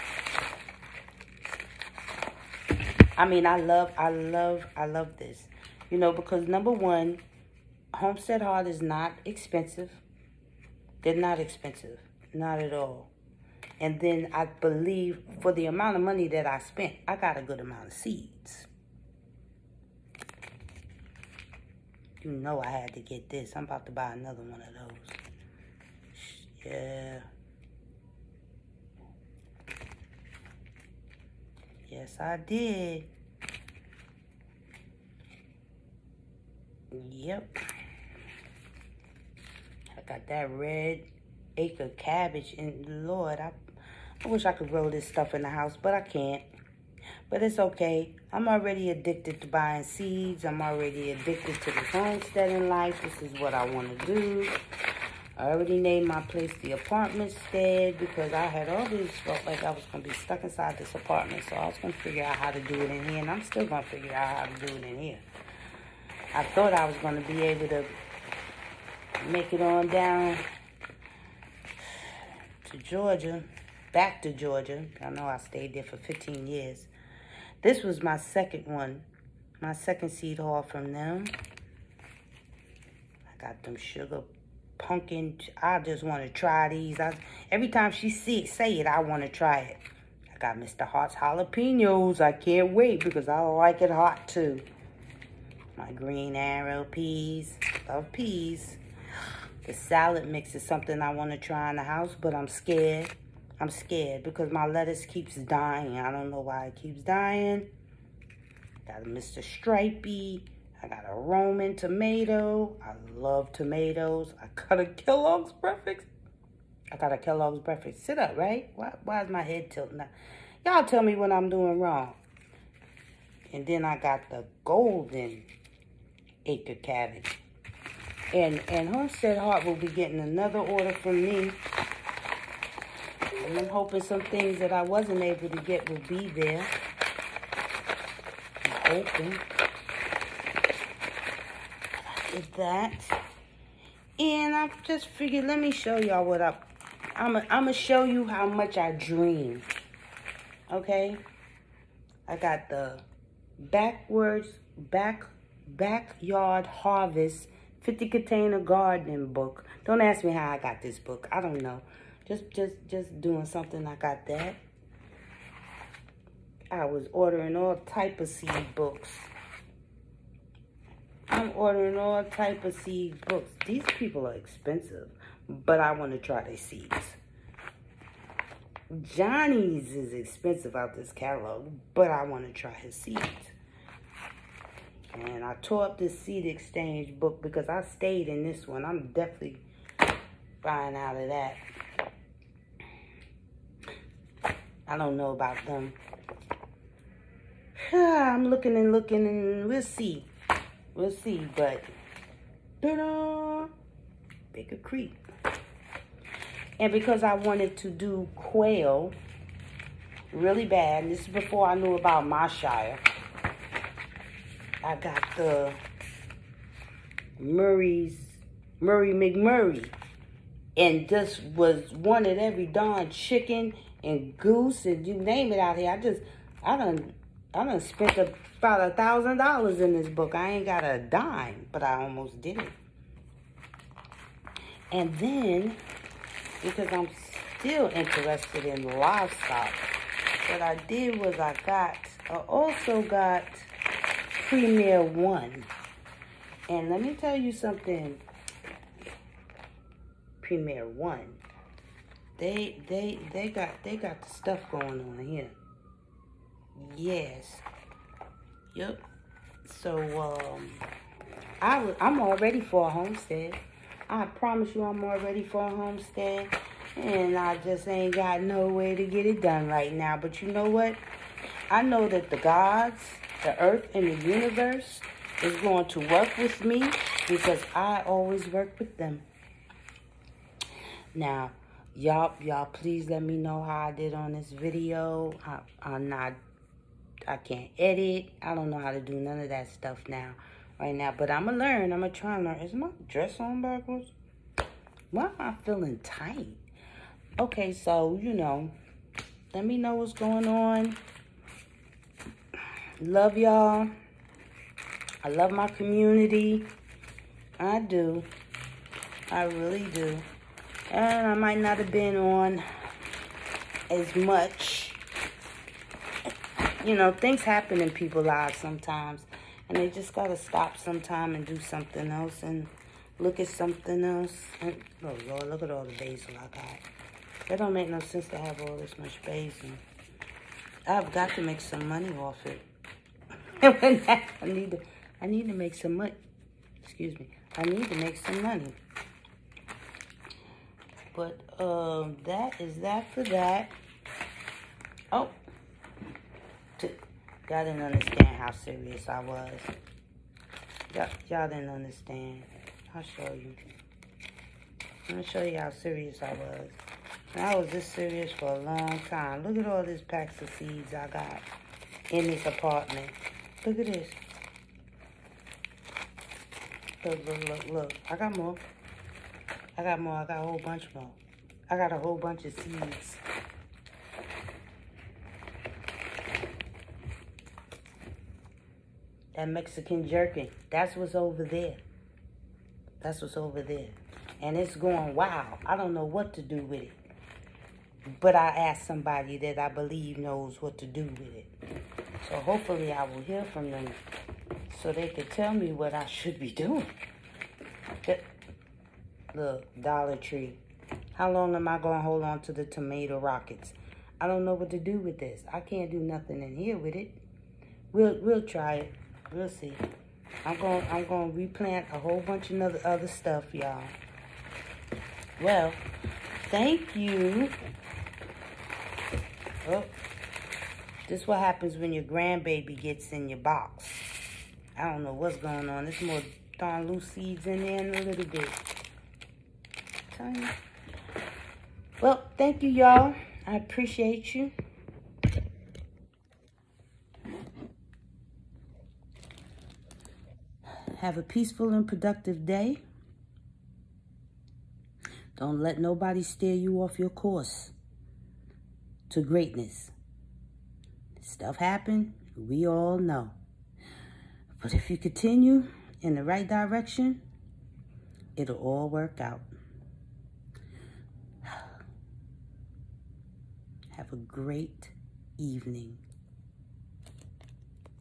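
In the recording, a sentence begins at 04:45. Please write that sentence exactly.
I, I'm not, I can't edit.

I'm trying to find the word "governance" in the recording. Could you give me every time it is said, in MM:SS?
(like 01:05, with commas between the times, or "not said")
not said.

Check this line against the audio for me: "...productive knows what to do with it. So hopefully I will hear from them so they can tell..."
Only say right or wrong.
wrong.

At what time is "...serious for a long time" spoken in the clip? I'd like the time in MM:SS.
05:57.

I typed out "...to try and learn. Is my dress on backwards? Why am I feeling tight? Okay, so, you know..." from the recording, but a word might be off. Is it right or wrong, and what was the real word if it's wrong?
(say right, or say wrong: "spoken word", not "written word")
right.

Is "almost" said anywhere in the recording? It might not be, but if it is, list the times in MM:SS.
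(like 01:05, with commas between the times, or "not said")
03:52.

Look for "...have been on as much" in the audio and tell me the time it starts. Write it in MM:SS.
05:11.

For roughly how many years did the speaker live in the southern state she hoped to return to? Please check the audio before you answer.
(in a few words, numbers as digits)
15.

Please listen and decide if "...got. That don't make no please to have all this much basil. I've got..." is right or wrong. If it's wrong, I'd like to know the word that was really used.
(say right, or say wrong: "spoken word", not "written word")
wrong: "sense", not "please".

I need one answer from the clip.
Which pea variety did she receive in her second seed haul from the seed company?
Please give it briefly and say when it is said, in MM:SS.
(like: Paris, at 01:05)
green arrow peas, at 01:35.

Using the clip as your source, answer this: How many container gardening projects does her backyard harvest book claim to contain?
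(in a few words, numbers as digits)
50.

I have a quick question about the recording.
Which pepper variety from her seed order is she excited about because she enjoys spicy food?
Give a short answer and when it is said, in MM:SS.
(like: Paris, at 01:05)
Mr. Hot's jalapenos, at 01:30.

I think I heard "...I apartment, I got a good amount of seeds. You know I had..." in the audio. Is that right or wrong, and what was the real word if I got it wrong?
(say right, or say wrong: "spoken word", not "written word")
wrong: "spent", not "apartment".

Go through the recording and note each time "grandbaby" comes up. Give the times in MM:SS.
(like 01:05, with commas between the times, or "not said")
07:02.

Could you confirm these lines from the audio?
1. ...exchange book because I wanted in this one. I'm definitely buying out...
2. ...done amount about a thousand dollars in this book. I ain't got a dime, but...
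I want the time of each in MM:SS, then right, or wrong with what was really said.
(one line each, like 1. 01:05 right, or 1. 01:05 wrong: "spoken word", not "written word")
1. 03:06 wrong: "stayed", not "wanted"
2. 03:47 wrong: "spent", not "amount".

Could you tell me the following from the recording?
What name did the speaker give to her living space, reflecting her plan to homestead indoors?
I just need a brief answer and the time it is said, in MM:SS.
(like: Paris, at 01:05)
the apartment stead, at 00:56.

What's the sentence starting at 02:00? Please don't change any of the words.
Y'all tell me what I'm doing wrong.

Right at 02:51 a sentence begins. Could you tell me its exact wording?
I'm ordering all type of seed books.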